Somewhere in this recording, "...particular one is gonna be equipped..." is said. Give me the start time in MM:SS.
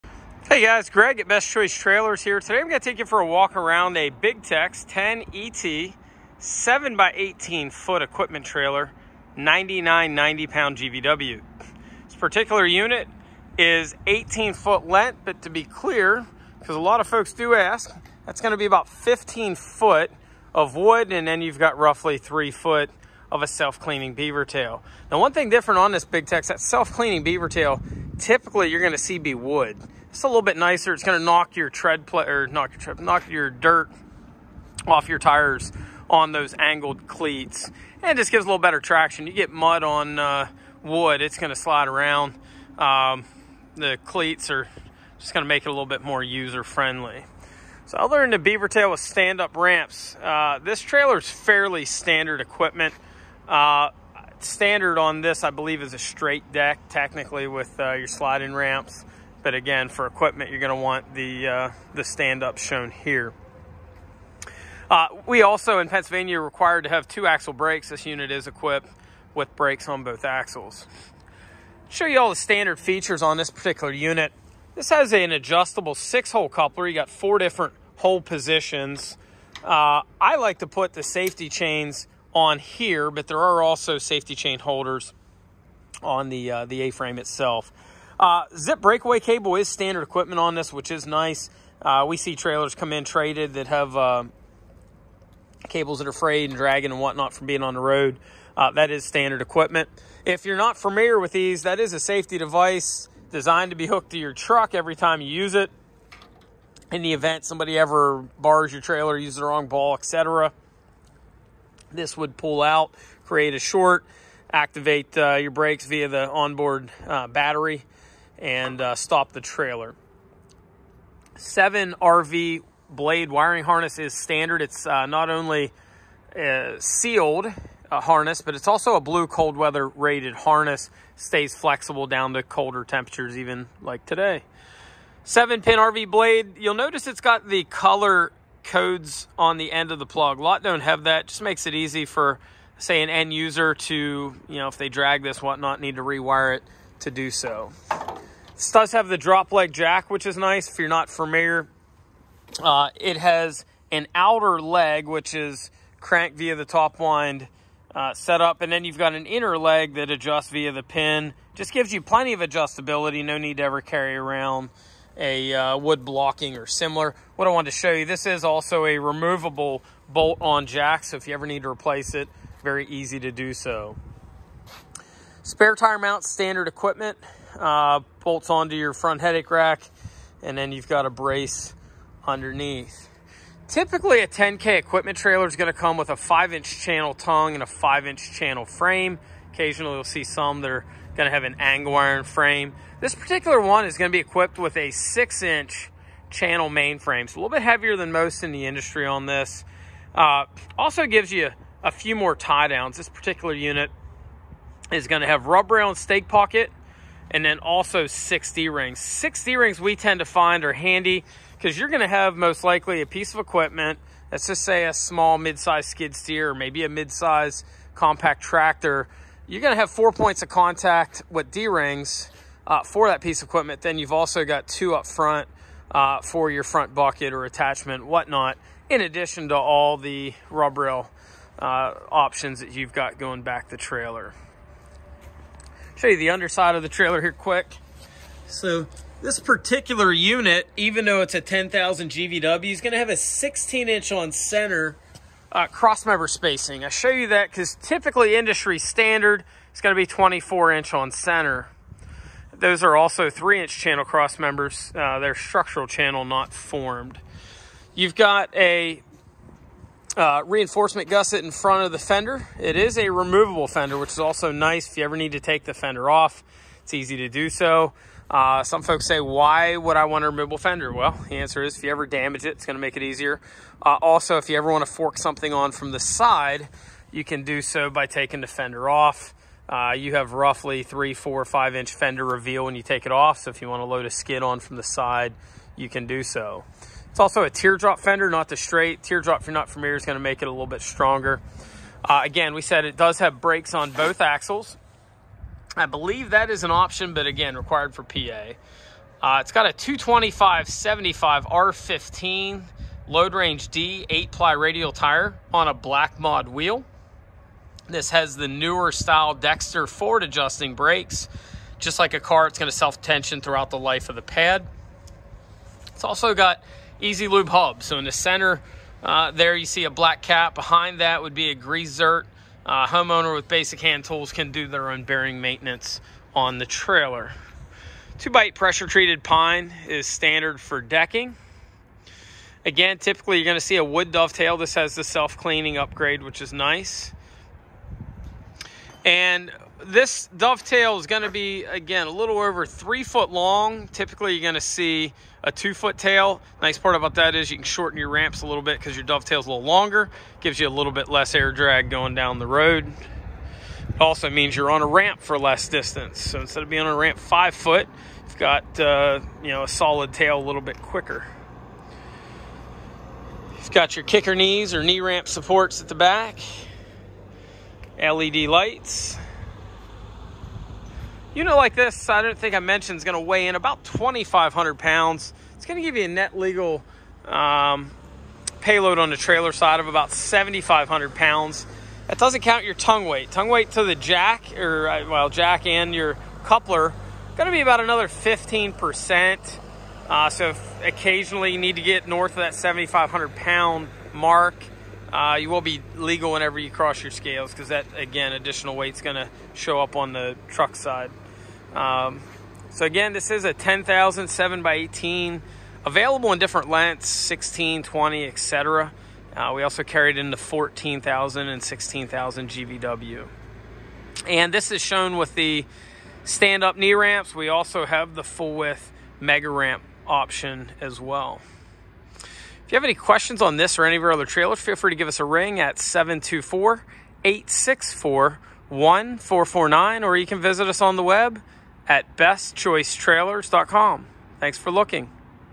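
03:13.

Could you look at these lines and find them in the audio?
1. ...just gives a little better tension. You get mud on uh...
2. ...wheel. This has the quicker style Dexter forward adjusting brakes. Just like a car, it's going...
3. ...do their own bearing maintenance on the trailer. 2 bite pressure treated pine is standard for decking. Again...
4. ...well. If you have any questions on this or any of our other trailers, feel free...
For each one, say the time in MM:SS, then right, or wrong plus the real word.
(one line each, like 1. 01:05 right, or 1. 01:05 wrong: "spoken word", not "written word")
1. 00:38 wrong: "traction", not "tension"
2. 05:06 wrong: "newer", not "quicker"
3. 05:24 right
4. 07:01 right.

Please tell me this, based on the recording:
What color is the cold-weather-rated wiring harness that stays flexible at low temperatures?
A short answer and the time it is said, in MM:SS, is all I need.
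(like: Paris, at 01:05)
Blue, at 02:08.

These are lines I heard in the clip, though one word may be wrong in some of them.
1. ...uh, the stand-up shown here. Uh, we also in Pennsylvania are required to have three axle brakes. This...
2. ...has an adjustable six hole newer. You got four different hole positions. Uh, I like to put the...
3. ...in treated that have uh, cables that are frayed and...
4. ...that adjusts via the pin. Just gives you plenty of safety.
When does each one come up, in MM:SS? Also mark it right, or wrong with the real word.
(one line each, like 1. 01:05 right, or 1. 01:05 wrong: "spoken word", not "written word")
1. 01:01 wrong: "two", not "three"
2. 01:14 wrong: "coupler", not "newer"
3. 01:32 wrong: "traded", not "treated"
4. 02:39 wrong: "adjustability", not "safety".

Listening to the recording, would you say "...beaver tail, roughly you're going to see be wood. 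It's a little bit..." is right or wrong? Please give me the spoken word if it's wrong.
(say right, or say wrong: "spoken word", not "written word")
wrong: "typically", not "roughly".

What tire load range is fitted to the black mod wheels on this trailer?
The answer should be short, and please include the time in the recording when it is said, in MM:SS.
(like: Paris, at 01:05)
Load range D, at 05:03.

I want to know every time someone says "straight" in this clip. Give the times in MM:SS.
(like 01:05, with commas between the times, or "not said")
00:55, 04:48.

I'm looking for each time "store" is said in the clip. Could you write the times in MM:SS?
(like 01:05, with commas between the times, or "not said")
not said.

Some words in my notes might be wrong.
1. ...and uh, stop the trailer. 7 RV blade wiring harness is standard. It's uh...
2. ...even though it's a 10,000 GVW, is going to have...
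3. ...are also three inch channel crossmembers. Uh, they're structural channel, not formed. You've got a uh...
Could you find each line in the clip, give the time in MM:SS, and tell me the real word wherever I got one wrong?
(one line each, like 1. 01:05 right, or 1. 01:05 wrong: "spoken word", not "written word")
1. 01:58 right
2. 04:00 right
3. 04:12 right.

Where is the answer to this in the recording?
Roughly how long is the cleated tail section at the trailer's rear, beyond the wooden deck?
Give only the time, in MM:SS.
00:21.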